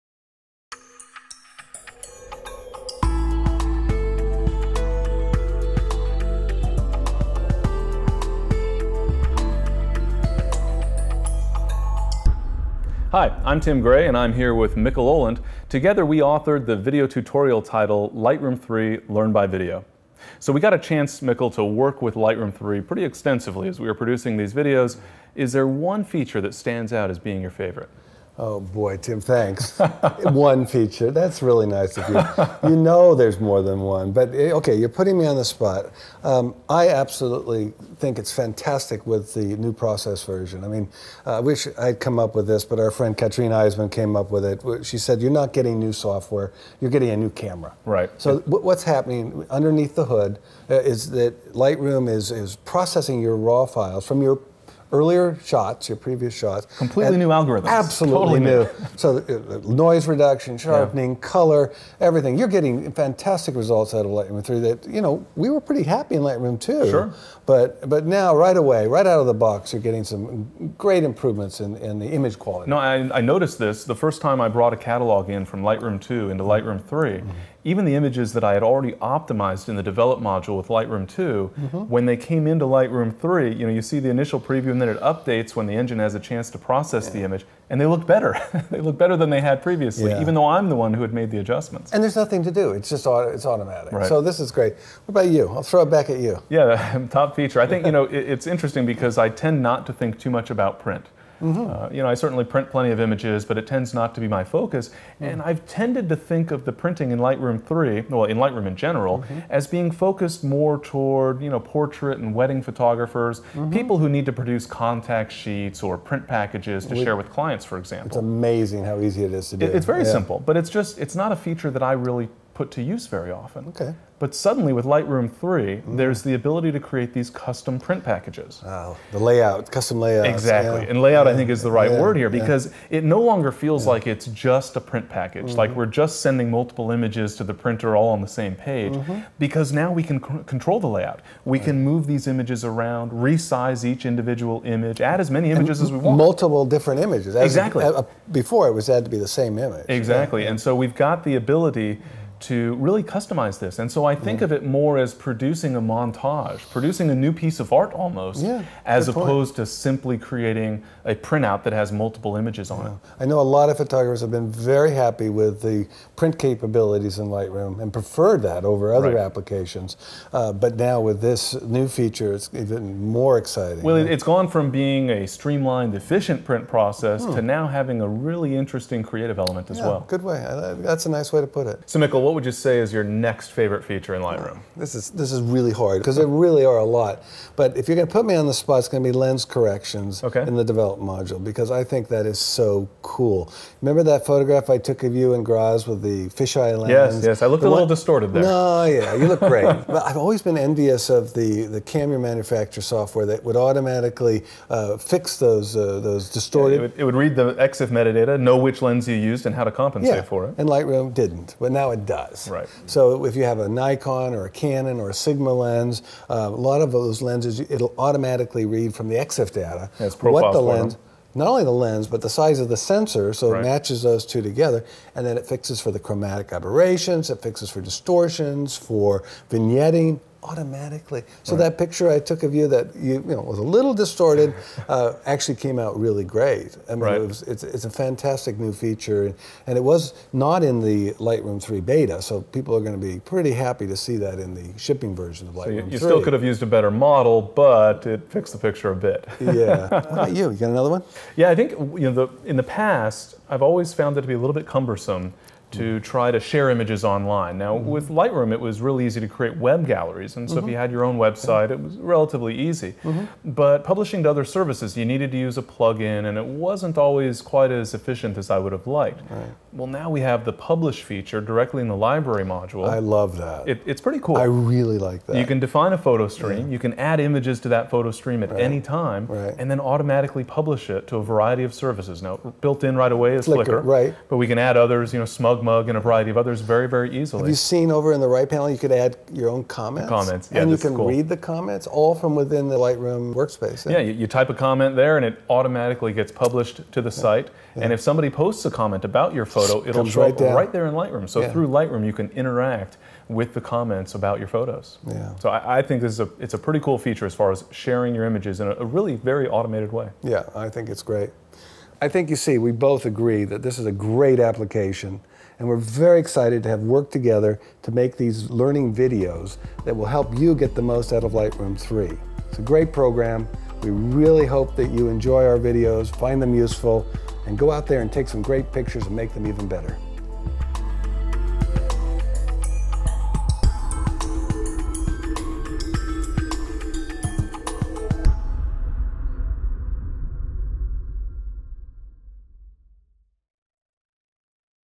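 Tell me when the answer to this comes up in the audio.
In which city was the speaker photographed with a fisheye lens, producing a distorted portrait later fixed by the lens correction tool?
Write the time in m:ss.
3:15.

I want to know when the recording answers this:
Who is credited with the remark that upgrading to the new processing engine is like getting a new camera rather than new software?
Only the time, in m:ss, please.
0:43.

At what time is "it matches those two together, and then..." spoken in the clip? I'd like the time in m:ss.
3:43.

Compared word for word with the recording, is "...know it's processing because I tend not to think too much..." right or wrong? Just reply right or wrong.
wrong.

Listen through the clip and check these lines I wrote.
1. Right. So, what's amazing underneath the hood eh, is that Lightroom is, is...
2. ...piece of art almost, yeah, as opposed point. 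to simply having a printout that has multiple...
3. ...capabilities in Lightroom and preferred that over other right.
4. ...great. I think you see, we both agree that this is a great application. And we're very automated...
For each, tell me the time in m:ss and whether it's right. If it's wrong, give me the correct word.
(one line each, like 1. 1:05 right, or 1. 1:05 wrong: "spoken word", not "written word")
1. 0:47 wrong: "happening", not "amazing"
2. 2:37 wrong: "creating", not "having"
3. 2:46 right
4. 5:11 wrong: "excited", not "automated".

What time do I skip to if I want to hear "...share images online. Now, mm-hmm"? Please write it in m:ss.
4:16.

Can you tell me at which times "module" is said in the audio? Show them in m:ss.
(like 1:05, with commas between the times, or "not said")
1:20, 3:11, 4:32.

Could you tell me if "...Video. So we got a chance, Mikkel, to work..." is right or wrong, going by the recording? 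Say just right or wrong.
right.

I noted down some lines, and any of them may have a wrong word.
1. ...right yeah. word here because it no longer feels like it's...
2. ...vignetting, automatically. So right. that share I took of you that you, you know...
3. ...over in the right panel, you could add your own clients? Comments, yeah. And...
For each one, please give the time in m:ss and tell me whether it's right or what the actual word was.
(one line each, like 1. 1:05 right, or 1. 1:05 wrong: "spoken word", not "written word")
1. 2:11 right
2. 3:49 wrong: "picture", not "share"
3. 4:47 wrong: "comments", not "clients".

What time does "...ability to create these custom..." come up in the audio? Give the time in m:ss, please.
2:06.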